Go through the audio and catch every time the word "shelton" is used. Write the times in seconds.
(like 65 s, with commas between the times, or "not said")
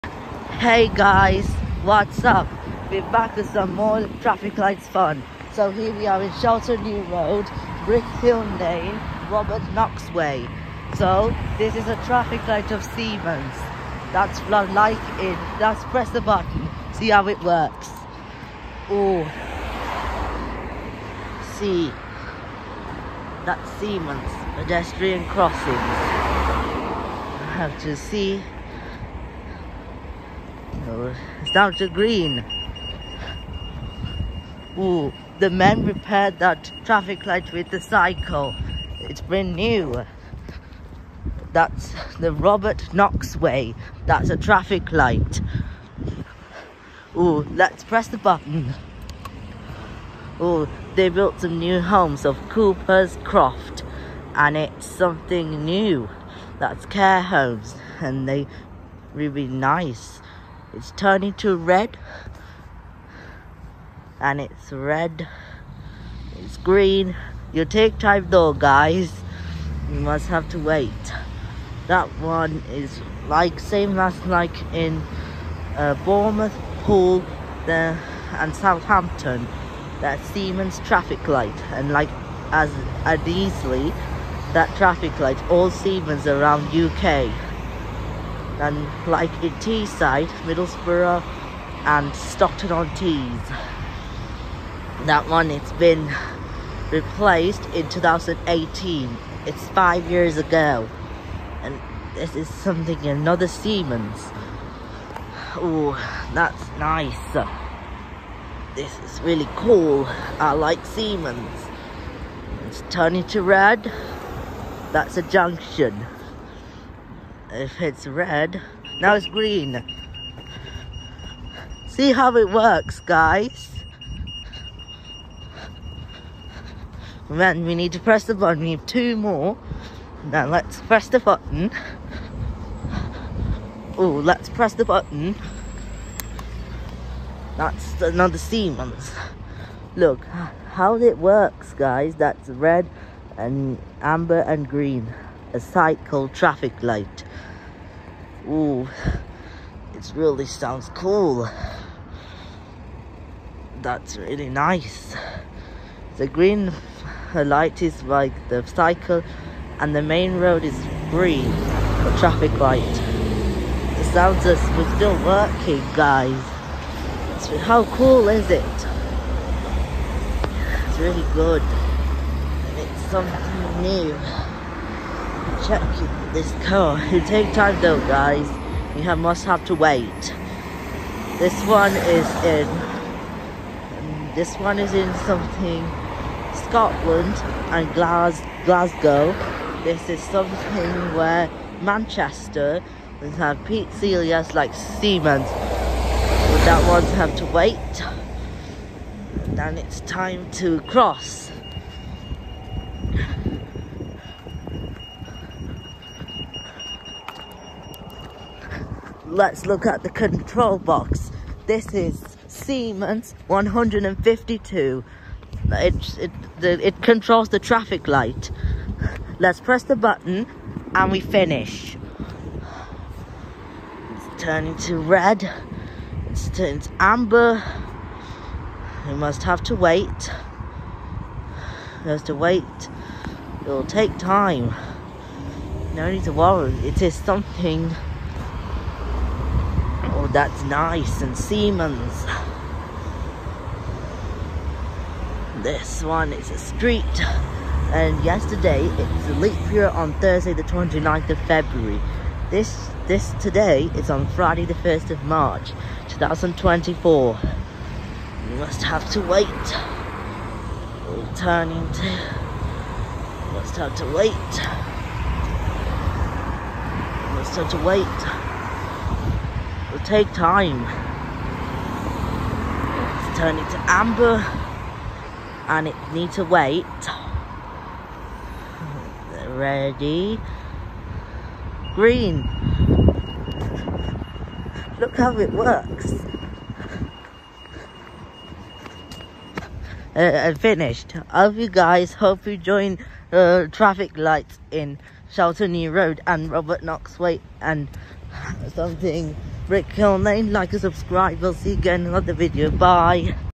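6 s, 295 s.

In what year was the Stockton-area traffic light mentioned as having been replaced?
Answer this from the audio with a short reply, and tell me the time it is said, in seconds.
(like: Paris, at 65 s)
2018, at 97 s.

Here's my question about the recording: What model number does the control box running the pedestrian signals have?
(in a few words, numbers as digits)
152.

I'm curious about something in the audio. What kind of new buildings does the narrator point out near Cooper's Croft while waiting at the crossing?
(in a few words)
Care homes.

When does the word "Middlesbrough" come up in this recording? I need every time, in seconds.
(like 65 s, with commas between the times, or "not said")
90 s.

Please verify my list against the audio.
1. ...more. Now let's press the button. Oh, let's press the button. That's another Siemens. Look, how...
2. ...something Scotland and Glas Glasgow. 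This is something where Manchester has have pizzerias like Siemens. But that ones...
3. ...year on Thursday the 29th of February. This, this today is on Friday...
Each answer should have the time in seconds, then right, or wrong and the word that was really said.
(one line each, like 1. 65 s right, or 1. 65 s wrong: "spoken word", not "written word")
1. 129 s right
2. 185 s right
3. 249 s right.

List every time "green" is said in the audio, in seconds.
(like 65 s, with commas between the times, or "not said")
31 s, 66 s, 119 s, 144 s, 156 s, 161 s, 281 s.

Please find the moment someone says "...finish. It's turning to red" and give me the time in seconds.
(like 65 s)
221 s.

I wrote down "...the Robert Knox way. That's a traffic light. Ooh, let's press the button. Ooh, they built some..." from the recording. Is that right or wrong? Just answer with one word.
right.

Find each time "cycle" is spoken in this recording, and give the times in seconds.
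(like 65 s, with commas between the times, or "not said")
37 s, 145 s, 158 s.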